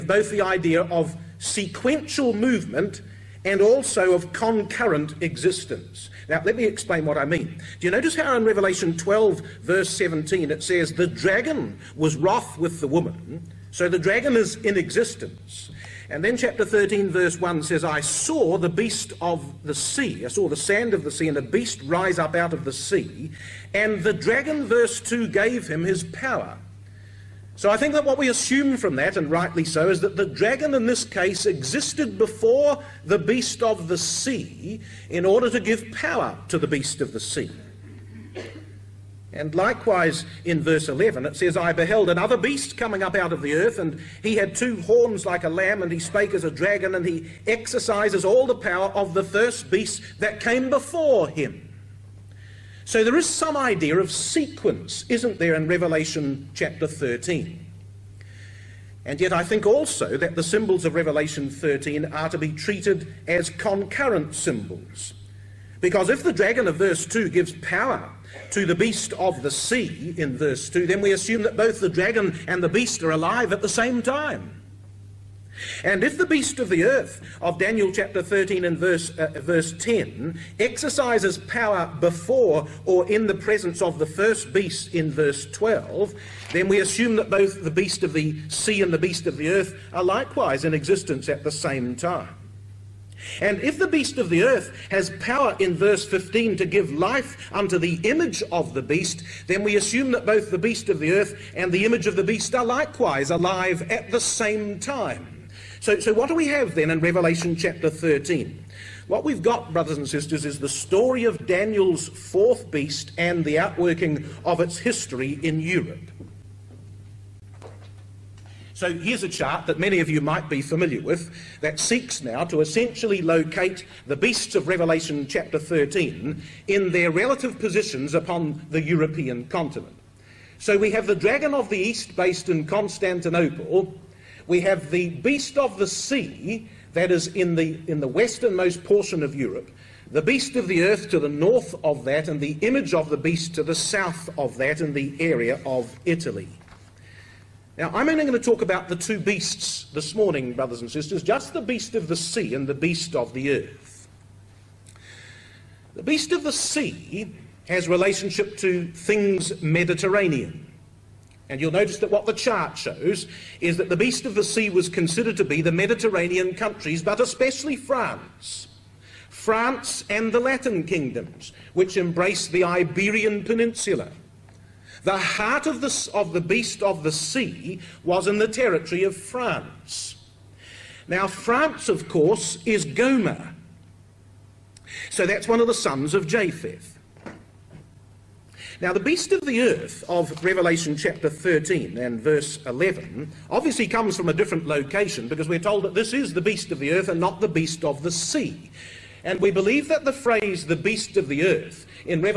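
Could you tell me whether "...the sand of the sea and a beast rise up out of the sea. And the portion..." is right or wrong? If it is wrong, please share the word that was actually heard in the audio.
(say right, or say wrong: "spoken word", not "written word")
wrong: "dragon", not "portion".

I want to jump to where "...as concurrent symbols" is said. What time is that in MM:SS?
01:03.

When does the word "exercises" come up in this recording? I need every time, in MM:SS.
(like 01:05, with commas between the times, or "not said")
00:47, 01:20.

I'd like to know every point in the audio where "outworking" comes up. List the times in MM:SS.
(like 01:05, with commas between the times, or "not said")
01:53.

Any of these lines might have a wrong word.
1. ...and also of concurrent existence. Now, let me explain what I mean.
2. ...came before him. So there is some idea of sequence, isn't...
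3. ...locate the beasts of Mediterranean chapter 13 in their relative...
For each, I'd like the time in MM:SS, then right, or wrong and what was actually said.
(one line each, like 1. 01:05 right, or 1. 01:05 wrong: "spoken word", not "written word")
1. 00:03 right
2. 00:50 right
3. 02:03 wrong: "Revelation", not "Mediterranean".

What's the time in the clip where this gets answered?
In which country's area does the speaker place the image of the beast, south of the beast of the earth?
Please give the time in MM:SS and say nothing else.
02:26.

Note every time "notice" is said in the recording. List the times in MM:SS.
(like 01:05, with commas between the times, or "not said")
00:07, 02:41.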